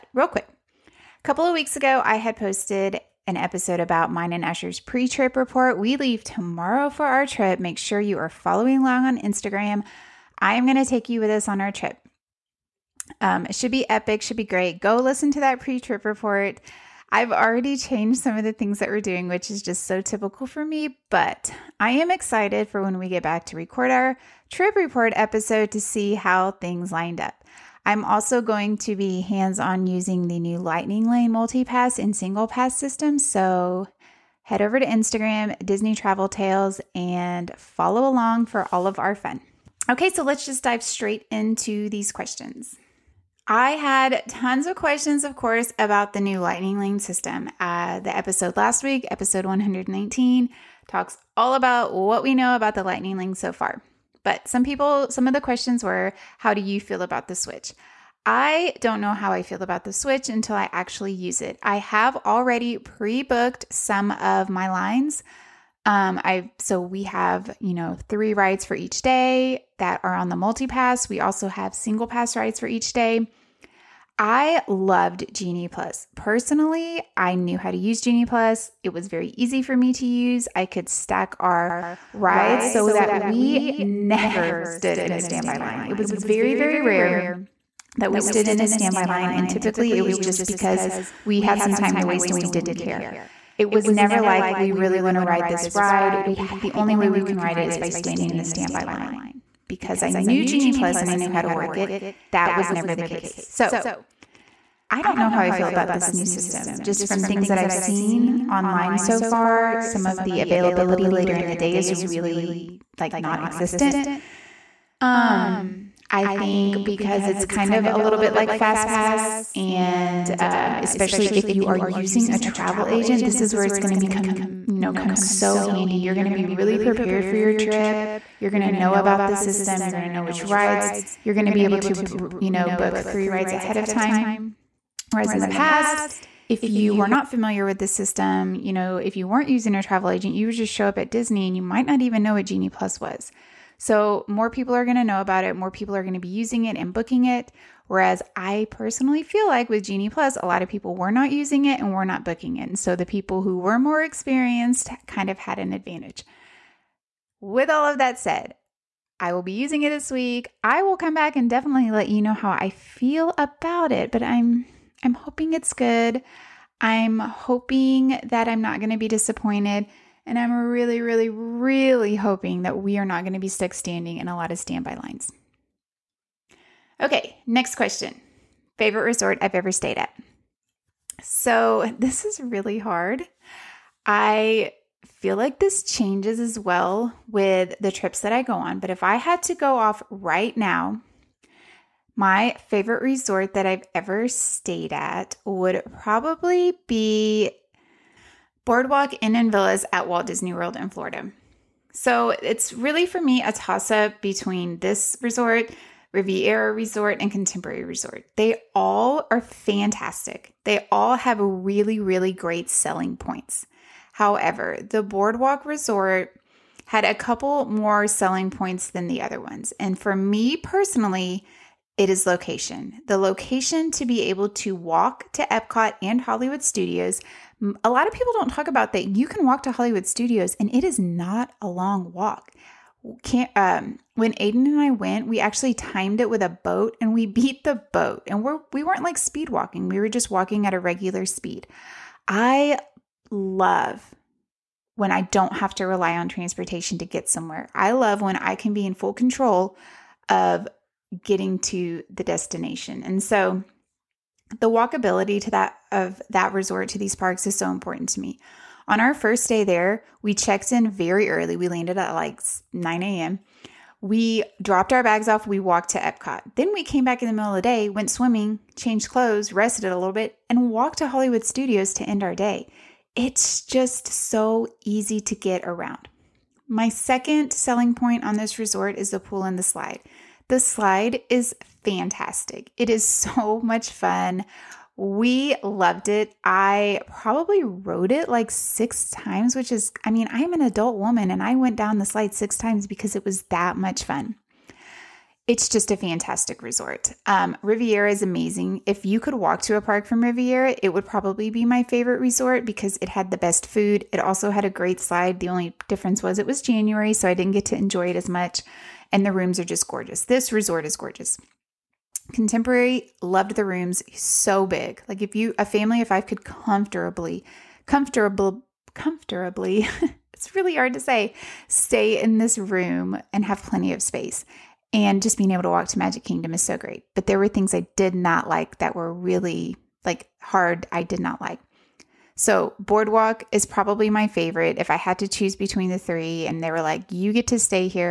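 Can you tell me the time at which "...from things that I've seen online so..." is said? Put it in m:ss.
1:47.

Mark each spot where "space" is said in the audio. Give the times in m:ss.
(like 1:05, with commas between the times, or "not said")
5:24.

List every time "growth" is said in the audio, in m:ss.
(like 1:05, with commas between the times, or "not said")
not said.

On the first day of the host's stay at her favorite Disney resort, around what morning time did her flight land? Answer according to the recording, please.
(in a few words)
9 a.m.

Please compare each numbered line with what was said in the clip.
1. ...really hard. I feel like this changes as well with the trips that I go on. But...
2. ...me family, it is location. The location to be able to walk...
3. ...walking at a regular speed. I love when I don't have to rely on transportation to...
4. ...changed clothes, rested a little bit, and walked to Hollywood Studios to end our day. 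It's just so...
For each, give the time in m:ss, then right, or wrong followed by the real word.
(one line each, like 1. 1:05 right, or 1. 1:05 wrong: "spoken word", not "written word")
1. 3:02 right
2. 3:40 wrong: "personally", not "family"
3. 4:00 right
4. 4:28 right.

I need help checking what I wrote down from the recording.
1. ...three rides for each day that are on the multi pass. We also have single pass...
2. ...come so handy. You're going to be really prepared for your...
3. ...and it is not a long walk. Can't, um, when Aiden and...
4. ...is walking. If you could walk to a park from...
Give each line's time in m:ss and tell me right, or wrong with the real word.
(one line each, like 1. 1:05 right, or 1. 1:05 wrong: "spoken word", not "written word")
1. 1:08 right
2. 2:04 right
3. 3:50 right
4. 4:58 wrong: "amazing", not "walking".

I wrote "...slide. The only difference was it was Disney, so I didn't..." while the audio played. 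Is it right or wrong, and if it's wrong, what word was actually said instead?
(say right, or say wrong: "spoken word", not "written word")
wrong: "January", not "Disney".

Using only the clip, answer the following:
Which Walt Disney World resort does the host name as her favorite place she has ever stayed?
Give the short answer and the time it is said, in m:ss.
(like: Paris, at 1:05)
Boardwalk Inn and Villas, at 3:18.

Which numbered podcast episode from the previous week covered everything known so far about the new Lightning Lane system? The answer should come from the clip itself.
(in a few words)
119.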